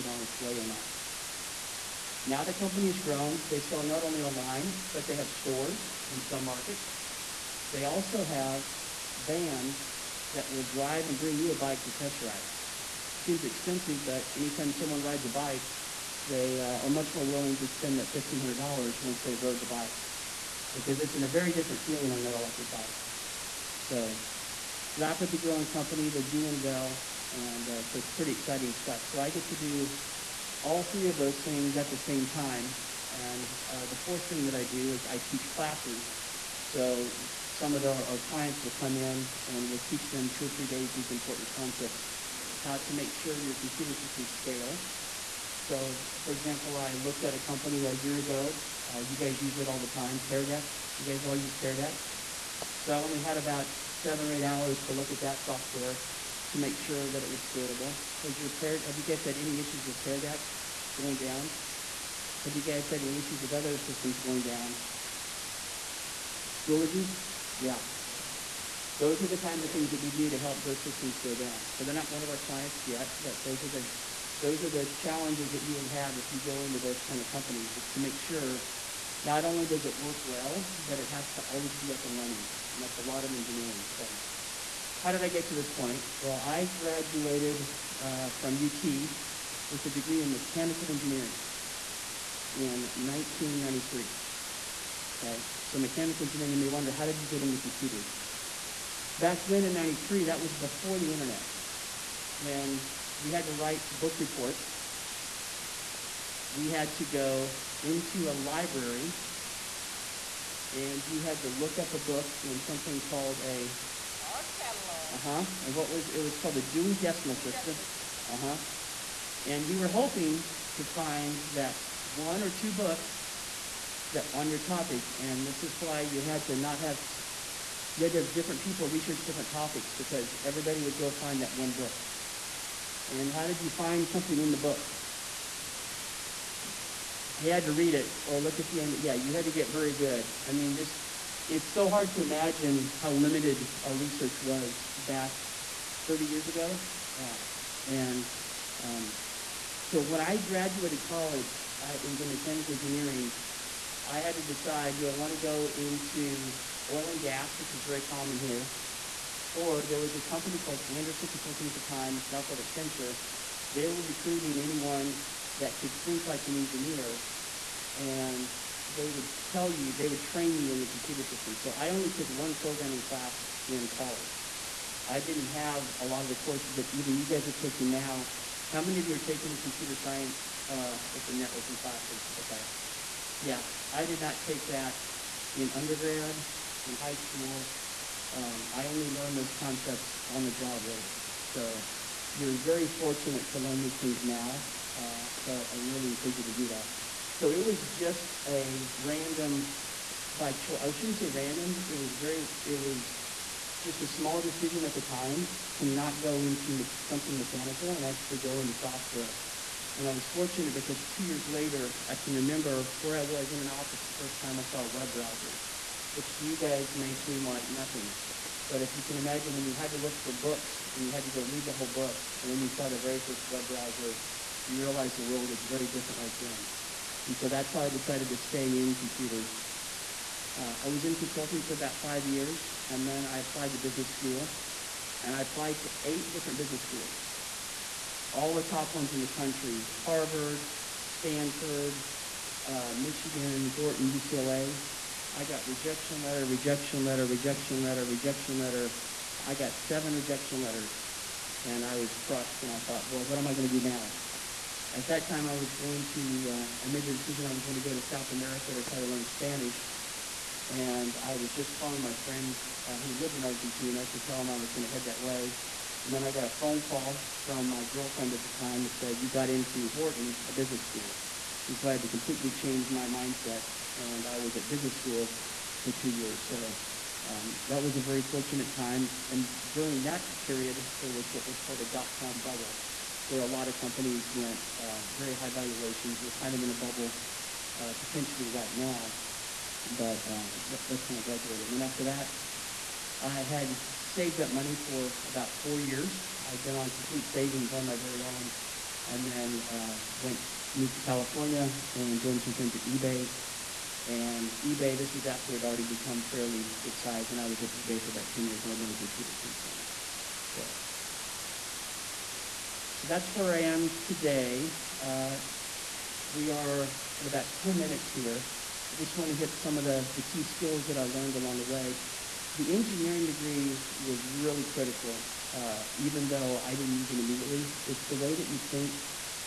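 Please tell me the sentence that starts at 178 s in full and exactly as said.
How many of you are taking a computer science uh, or some networking classes?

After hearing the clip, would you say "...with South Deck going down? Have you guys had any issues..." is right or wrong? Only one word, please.
wrong.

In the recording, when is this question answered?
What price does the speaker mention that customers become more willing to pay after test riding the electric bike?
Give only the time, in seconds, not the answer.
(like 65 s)
18 s.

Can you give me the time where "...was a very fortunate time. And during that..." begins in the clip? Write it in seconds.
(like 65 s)
277 s.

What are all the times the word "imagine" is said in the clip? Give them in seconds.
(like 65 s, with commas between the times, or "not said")
142 s, 219 s.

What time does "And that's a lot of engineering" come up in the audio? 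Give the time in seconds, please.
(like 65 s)
82 s.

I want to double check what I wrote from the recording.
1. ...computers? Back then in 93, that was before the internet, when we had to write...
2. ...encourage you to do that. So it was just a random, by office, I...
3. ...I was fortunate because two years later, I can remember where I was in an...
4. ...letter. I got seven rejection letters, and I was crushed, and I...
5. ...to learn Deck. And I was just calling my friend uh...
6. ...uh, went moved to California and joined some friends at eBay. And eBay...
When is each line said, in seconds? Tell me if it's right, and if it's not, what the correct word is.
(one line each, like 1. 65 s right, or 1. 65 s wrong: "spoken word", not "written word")
1. 97 s right
2. 196 s wrong: "choice", not "office"
3. 210 s right
4. 248 s right
5. 259 s wrong: "Spanish", not "Deck"
6. 299 s right.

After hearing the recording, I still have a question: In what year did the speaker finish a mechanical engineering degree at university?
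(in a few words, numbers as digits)
1993.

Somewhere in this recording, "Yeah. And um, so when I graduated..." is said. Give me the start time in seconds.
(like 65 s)
147 s.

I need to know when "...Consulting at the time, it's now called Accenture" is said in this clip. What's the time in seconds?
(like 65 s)
161 s.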